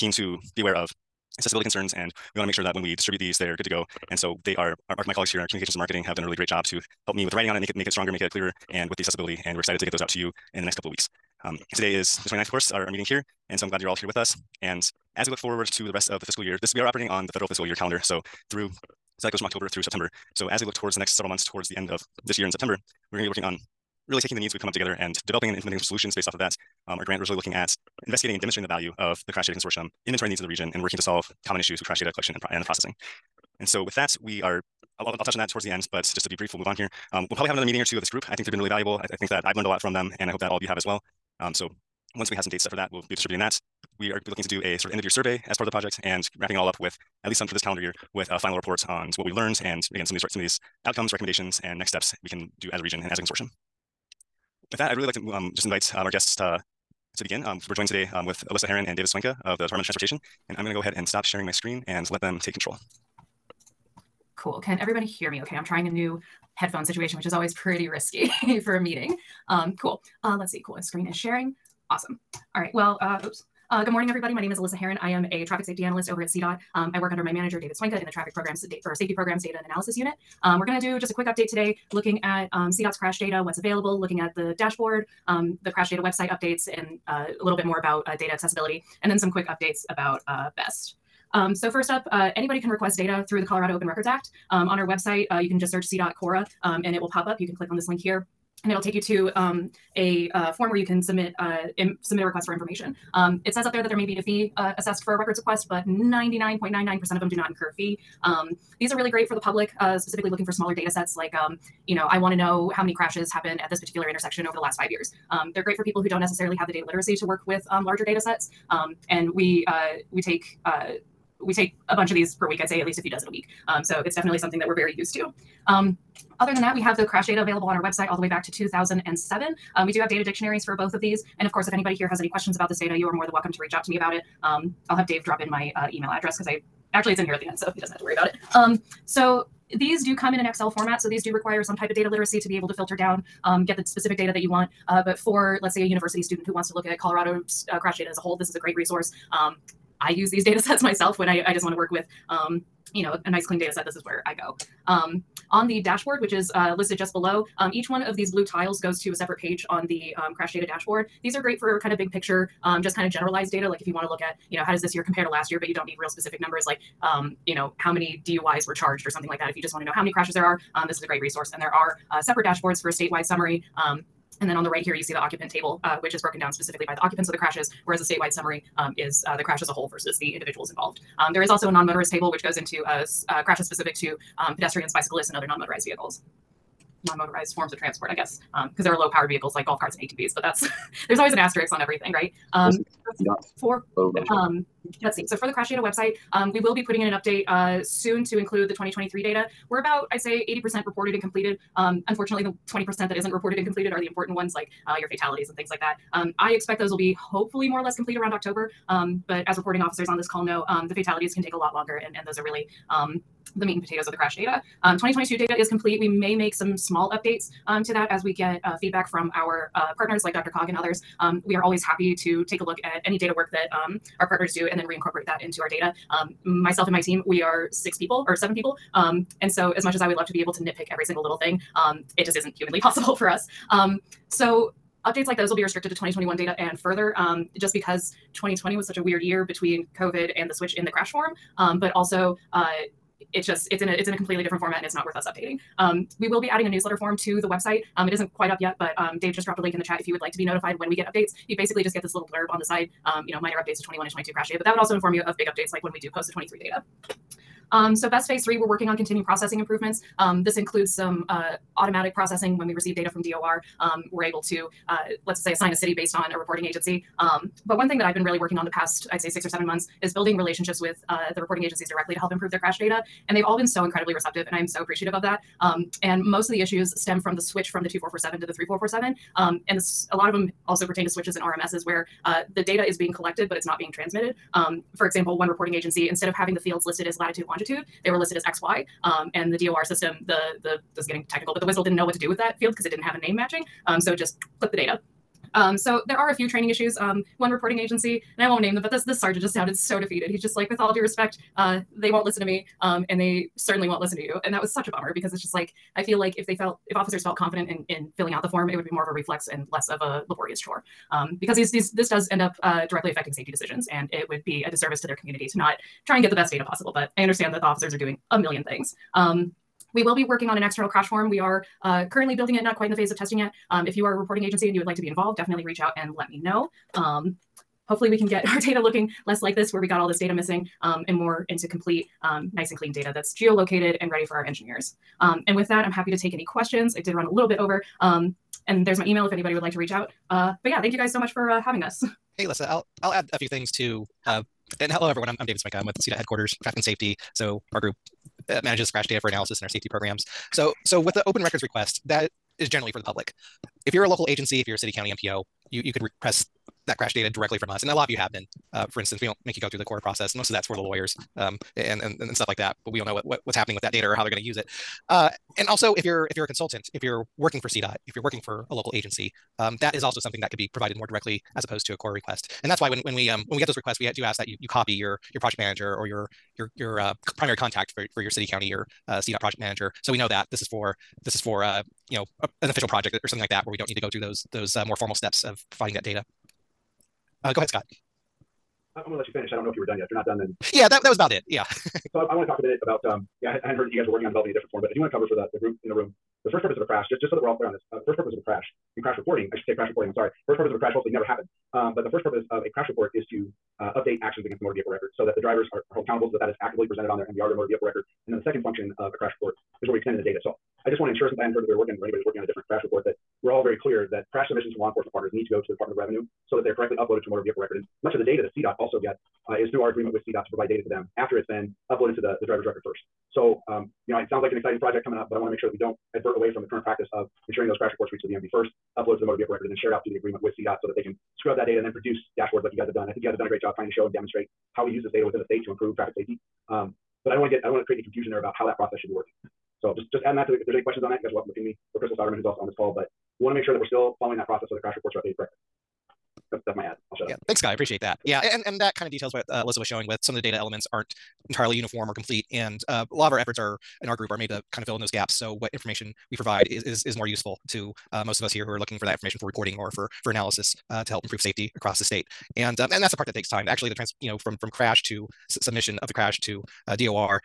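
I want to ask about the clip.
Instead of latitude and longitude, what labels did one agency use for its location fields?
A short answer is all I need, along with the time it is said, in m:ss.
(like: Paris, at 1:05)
XY, at 4:48.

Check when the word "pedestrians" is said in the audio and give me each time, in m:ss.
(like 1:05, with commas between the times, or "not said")
3:04.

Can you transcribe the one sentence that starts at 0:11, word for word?
Um, today is the 29th, of course, our, our meeting here.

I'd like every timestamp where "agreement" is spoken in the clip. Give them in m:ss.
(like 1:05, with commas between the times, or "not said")
6:59, 7:10.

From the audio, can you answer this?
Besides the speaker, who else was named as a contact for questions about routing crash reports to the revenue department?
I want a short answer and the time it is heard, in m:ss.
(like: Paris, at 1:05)
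Crystal Soderman, at 7:21.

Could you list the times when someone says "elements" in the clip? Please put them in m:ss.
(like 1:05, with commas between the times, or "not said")
7:30.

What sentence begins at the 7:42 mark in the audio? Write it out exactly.
And um, and that's the part that takes time.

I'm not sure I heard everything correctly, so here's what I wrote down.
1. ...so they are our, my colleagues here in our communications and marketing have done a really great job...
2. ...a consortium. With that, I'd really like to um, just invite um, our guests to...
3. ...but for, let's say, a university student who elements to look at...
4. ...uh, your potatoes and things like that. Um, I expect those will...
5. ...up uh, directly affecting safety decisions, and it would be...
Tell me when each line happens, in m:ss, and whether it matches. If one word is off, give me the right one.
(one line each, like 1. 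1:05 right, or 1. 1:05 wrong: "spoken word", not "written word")
1. 0:04 right
2. 0:53 right
3. 2:25 wrong: "wants", not "elements"
4. 3:24 wrong: "fatalities", not "potatoes"
5. 5:12 right.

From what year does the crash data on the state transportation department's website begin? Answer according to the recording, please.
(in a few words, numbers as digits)
2007.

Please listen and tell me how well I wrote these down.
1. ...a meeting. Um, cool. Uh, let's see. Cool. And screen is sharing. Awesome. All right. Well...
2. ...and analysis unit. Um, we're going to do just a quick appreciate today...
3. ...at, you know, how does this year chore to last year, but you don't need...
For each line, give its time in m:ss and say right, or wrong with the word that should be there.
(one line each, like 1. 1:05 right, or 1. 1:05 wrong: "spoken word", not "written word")
1. 1:08 right
2. 1:19 wrong: "update", not "appreciate"
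3. 2:44 wrong: "compare", not "chore".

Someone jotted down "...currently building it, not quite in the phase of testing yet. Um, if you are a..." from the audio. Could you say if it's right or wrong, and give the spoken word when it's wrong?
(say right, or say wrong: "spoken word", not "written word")
right.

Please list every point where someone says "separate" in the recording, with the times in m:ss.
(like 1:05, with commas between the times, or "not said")
2:39, 2:52.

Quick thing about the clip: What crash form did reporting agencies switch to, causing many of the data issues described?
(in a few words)
3447.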